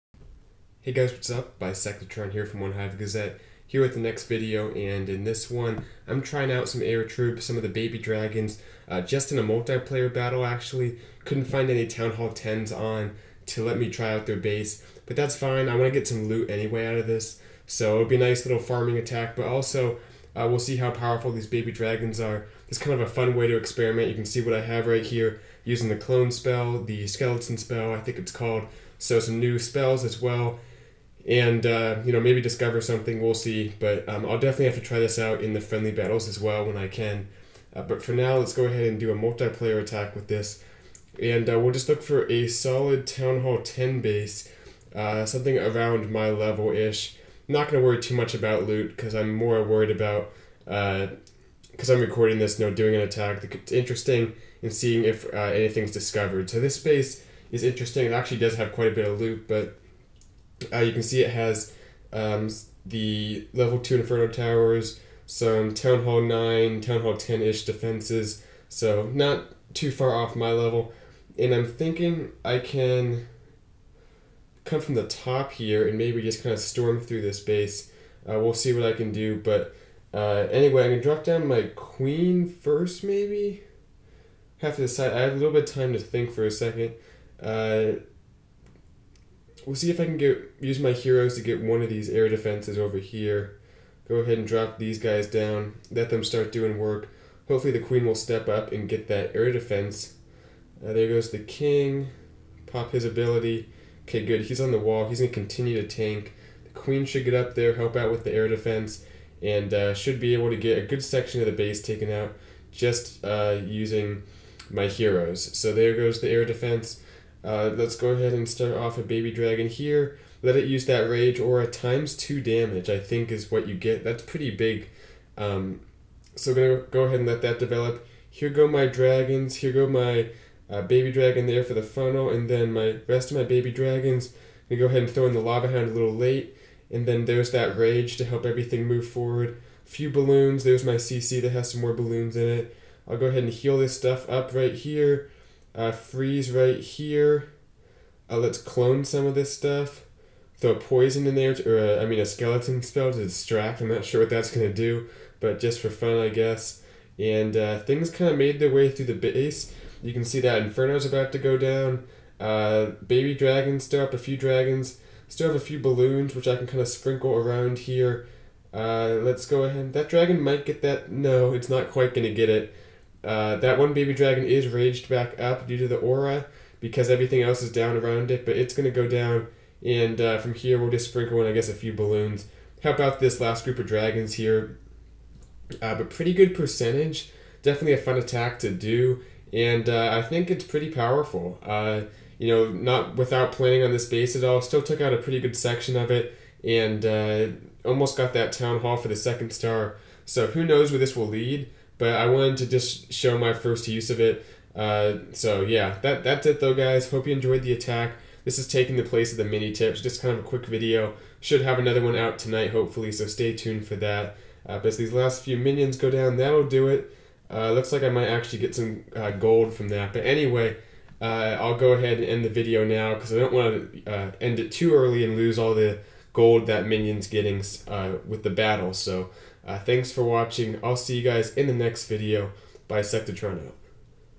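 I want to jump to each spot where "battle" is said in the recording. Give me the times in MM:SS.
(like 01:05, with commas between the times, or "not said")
00:10, 00:35, 03:48.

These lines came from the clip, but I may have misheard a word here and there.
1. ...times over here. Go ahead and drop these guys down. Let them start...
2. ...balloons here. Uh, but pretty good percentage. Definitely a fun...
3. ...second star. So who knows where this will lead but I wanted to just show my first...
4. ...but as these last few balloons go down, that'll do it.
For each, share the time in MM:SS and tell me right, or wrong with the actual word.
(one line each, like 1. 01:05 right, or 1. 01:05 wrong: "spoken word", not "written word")
1. 01:32 wrong: "defenses", not "times"
2. 03:03 wrong: "dragons", not "balloons"
3. 03:19 right
4. 03:34 wrong: "minions", not "balloons".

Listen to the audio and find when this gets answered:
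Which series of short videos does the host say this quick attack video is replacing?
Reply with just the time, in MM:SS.
03:29.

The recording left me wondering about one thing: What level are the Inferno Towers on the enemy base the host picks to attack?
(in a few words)
2.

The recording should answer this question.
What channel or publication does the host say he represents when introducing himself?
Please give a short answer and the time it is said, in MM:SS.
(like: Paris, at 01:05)
One Hive Gazette, at 00:02.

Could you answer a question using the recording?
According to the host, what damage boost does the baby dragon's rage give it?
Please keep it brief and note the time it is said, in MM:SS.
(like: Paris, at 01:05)
times two damage, at 02:01.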